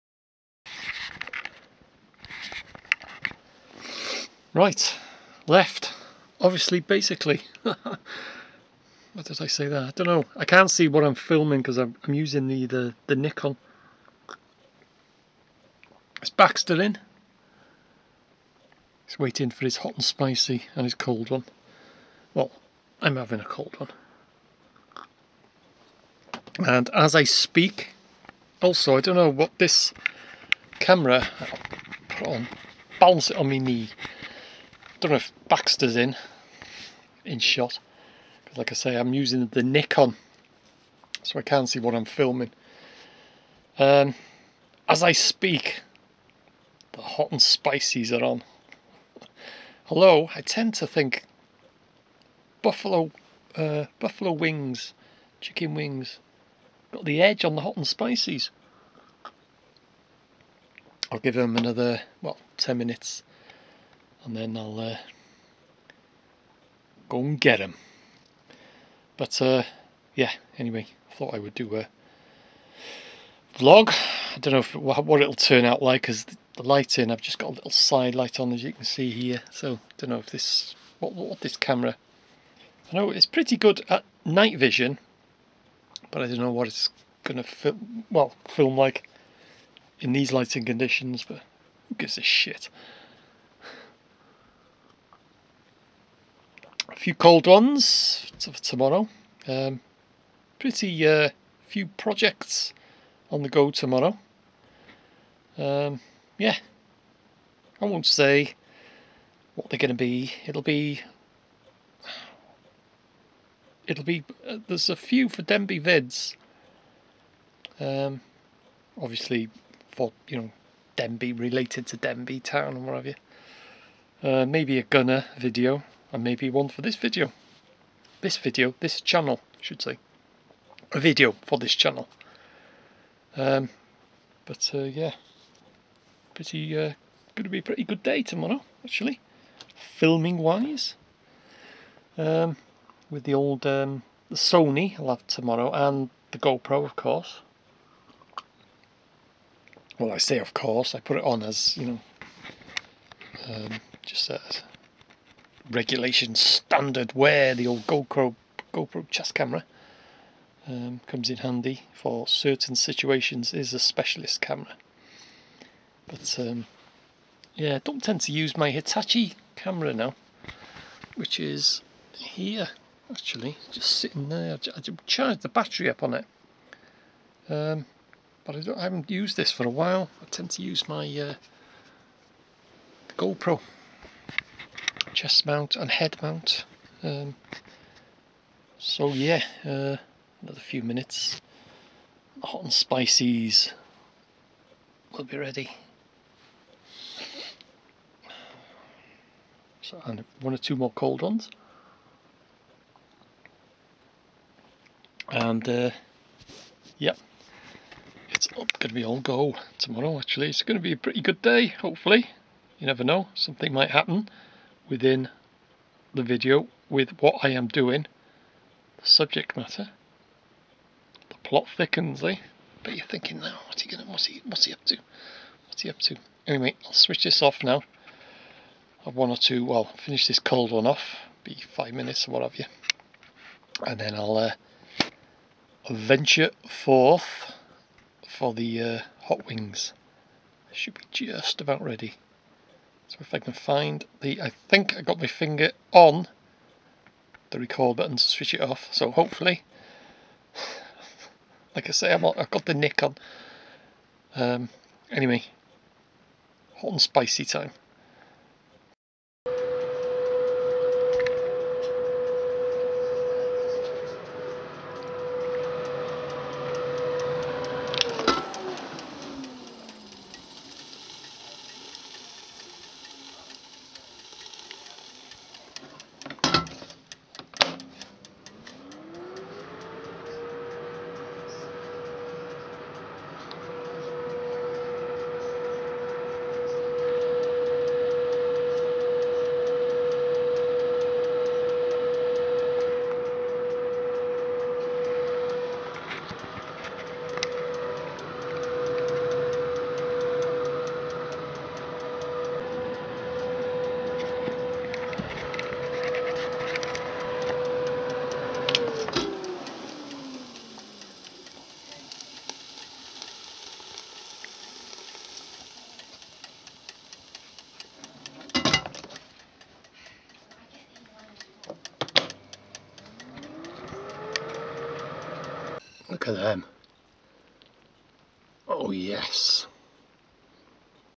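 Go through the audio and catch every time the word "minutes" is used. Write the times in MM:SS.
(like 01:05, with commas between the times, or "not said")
01:02, 03:10, 03:51.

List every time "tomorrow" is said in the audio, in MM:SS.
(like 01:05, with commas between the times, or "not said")
01:38, 01:43, 02:18, 02:25, 03:29.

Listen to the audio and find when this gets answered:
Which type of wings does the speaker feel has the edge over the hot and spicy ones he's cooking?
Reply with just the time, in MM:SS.
00:53.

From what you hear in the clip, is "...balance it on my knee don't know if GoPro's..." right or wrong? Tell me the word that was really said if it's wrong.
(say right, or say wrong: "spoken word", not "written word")
wrong: "Baxter", not "GoPro".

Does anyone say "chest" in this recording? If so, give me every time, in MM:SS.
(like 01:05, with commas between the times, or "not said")
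02:39, 03:05.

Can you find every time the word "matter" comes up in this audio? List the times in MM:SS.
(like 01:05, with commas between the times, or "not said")
03:39.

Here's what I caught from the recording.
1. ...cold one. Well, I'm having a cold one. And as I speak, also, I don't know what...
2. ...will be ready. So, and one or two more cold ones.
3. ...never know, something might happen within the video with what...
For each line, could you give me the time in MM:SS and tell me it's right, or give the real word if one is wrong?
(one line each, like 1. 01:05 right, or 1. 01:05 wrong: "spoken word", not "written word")
1. 00:20 right
2. 03:15 right
3. 03:32 right.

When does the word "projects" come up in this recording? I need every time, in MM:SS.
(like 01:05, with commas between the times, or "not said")
01:41.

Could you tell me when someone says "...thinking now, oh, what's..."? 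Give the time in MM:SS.
03:43.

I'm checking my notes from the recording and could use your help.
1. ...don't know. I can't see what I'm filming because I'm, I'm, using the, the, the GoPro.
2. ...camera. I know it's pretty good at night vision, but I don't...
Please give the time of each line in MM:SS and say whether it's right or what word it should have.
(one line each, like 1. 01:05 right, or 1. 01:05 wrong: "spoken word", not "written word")
1. 00:09 wrong: "Nikon", not "GoPro"
2. 01:21 right.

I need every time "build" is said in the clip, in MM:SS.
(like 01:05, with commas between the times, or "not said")
not said.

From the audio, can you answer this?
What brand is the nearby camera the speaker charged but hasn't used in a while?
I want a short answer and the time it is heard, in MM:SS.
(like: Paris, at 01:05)
Hitachi, at 02:48.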